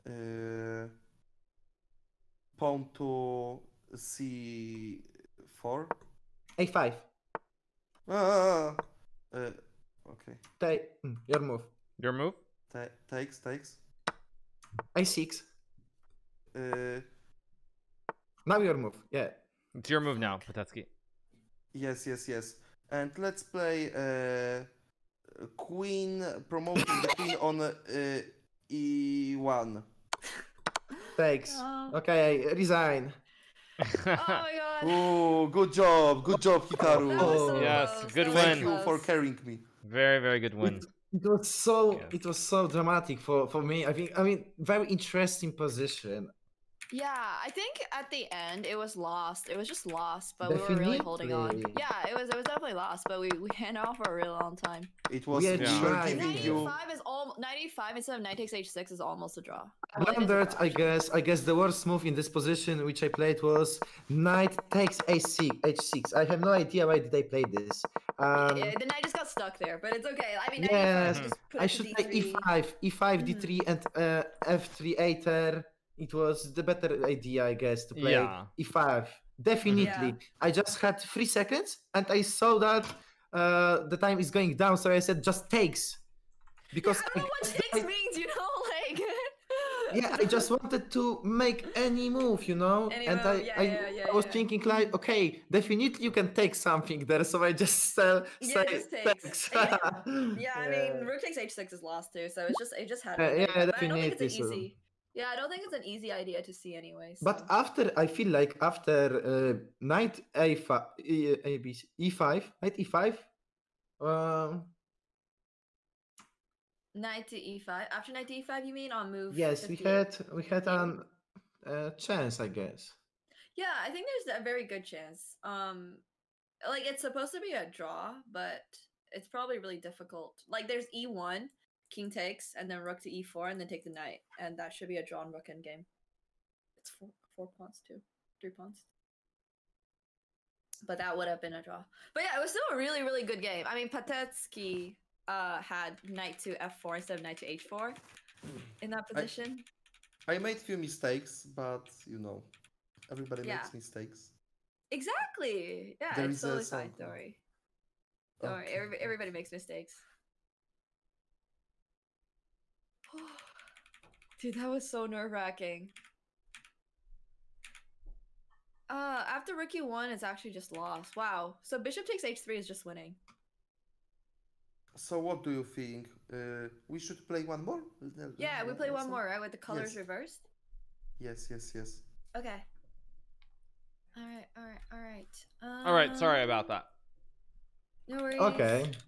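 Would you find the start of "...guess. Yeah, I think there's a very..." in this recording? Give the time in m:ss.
2:02.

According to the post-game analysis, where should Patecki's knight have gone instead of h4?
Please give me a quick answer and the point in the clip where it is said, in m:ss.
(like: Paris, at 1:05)
f4, at 2:26.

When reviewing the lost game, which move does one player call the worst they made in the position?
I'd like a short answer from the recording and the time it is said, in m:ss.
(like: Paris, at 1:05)
Knight takes h6, at 1:04.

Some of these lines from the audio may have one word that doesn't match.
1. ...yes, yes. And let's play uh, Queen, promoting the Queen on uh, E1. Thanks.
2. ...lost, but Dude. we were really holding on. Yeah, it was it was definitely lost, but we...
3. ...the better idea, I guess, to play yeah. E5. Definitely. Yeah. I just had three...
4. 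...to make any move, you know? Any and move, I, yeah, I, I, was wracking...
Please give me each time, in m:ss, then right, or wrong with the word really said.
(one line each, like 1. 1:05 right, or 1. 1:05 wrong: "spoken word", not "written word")
1. 0:22 right
2. 0:49 wrong: "Definitely", not "Dude"
3. 1:16 right
4. 1:30 wrong: "thinking", not "wracking".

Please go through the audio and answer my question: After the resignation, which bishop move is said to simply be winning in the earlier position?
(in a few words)
Bishop takes h3.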